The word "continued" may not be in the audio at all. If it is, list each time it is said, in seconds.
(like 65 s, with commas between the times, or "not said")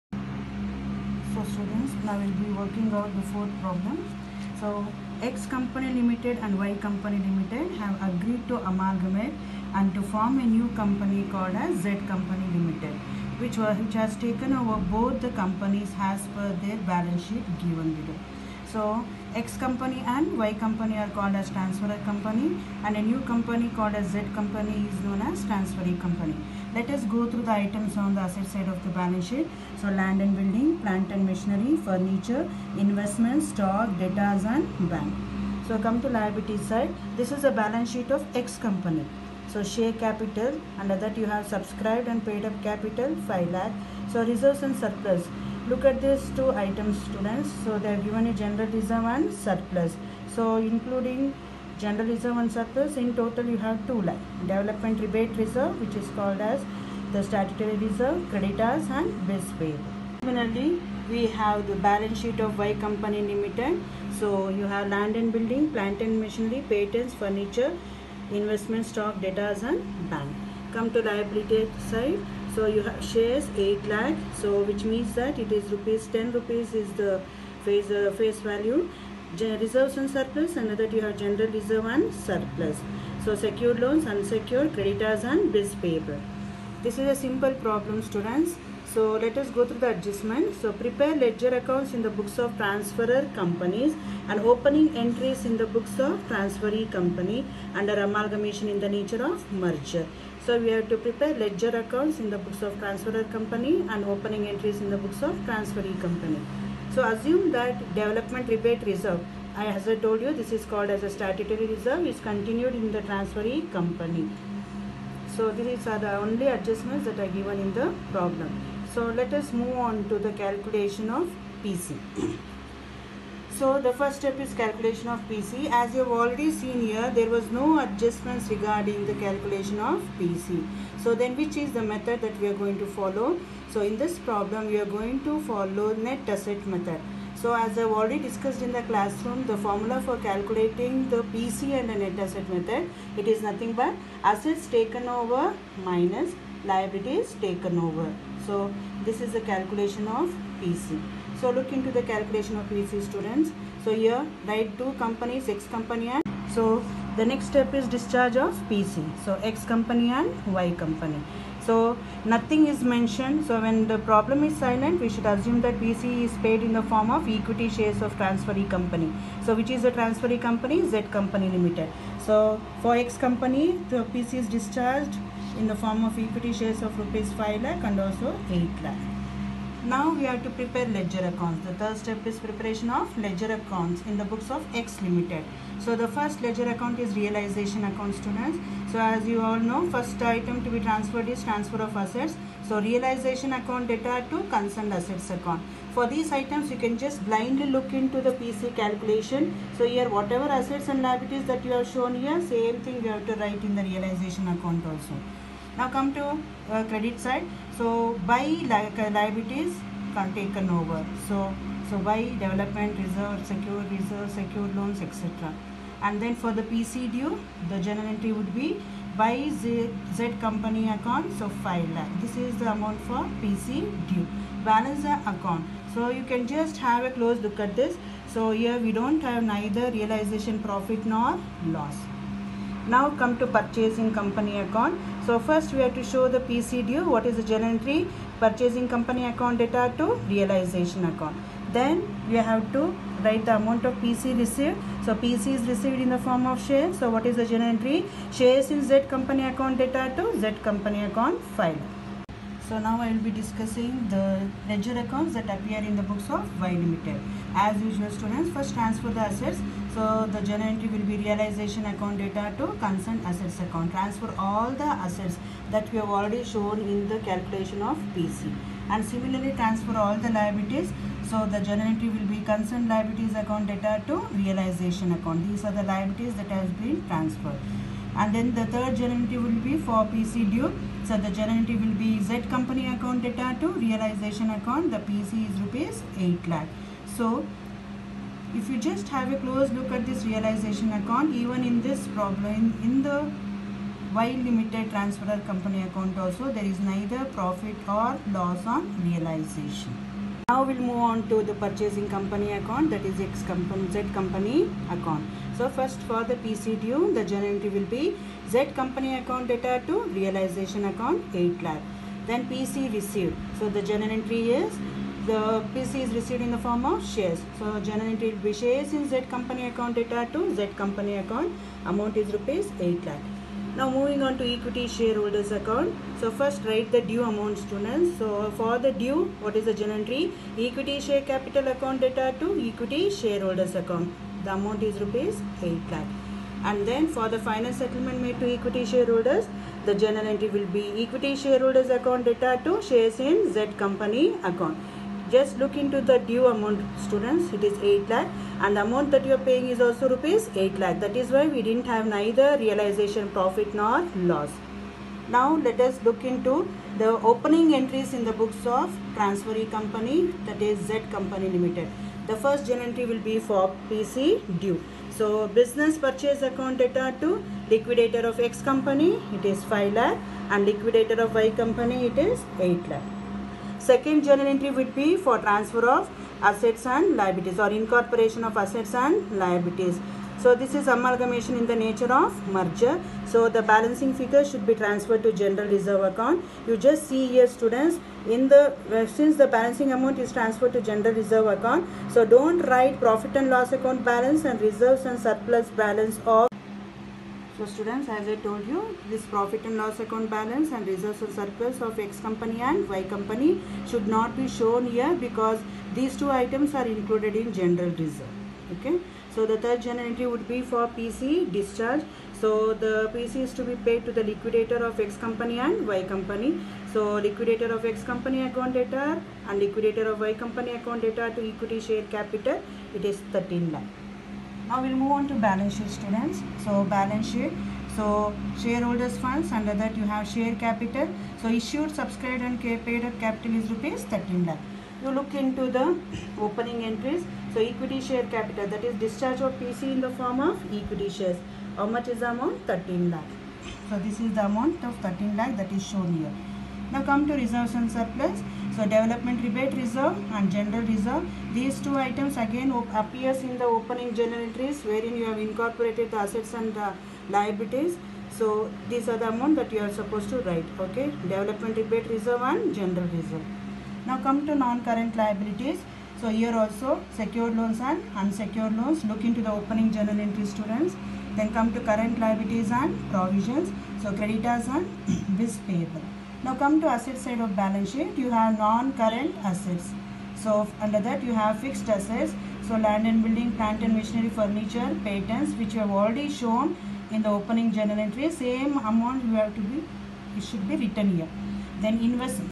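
112 s.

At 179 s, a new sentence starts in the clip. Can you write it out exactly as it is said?
Now we have to prepare ledger accounts.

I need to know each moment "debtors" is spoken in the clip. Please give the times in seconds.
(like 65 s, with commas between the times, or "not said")
33 s, 69 s.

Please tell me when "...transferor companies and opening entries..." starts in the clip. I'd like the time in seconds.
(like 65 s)
92 s.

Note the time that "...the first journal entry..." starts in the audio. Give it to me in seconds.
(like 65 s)
362 s.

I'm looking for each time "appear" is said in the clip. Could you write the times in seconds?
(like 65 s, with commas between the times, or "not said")
255 s, 452 s.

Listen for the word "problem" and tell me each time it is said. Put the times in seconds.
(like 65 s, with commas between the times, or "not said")
3 s, 87 s, 118 s, 134 s, 163 s, 292 s.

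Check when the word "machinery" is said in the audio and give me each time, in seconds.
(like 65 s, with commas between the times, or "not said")
31 s, 66 s, 483 s.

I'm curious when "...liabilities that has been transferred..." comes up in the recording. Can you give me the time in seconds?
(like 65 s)
275 s.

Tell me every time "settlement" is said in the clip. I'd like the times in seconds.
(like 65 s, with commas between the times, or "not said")
337 s.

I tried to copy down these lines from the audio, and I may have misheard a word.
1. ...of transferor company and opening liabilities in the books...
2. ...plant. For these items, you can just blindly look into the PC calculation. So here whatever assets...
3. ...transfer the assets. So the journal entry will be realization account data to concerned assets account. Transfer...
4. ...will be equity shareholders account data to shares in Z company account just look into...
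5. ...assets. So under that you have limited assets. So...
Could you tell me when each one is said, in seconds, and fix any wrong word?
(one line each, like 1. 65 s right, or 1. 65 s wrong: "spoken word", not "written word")
1. 102 s wrong: "entries", not "liabilities"
2. 195 s wrong: "account", not "plant"
3. 258 s right
4. 340 s right
5. 479 s wrong: "fixed", not "limited".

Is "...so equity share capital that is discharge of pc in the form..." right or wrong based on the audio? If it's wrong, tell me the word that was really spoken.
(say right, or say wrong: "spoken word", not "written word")
right.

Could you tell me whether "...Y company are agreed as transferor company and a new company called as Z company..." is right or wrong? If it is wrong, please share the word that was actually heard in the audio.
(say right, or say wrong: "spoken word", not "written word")
wrong: "called", not "agreed".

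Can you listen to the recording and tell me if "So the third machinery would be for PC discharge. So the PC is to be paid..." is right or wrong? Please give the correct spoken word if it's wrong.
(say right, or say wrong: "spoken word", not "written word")
wrong: "entry", not "machinery".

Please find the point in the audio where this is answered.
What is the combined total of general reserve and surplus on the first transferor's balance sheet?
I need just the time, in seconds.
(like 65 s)
53 s.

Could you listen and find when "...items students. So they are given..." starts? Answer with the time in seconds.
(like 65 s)
46 s.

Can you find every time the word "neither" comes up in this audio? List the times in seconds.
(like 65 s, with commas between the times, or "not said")
229 s, 296 s, 352 s.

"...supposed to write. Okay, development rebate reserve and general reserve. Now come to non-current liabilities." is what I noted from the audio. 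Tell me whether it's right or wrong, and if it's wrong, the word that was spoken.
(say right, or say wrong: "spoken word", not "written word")
right.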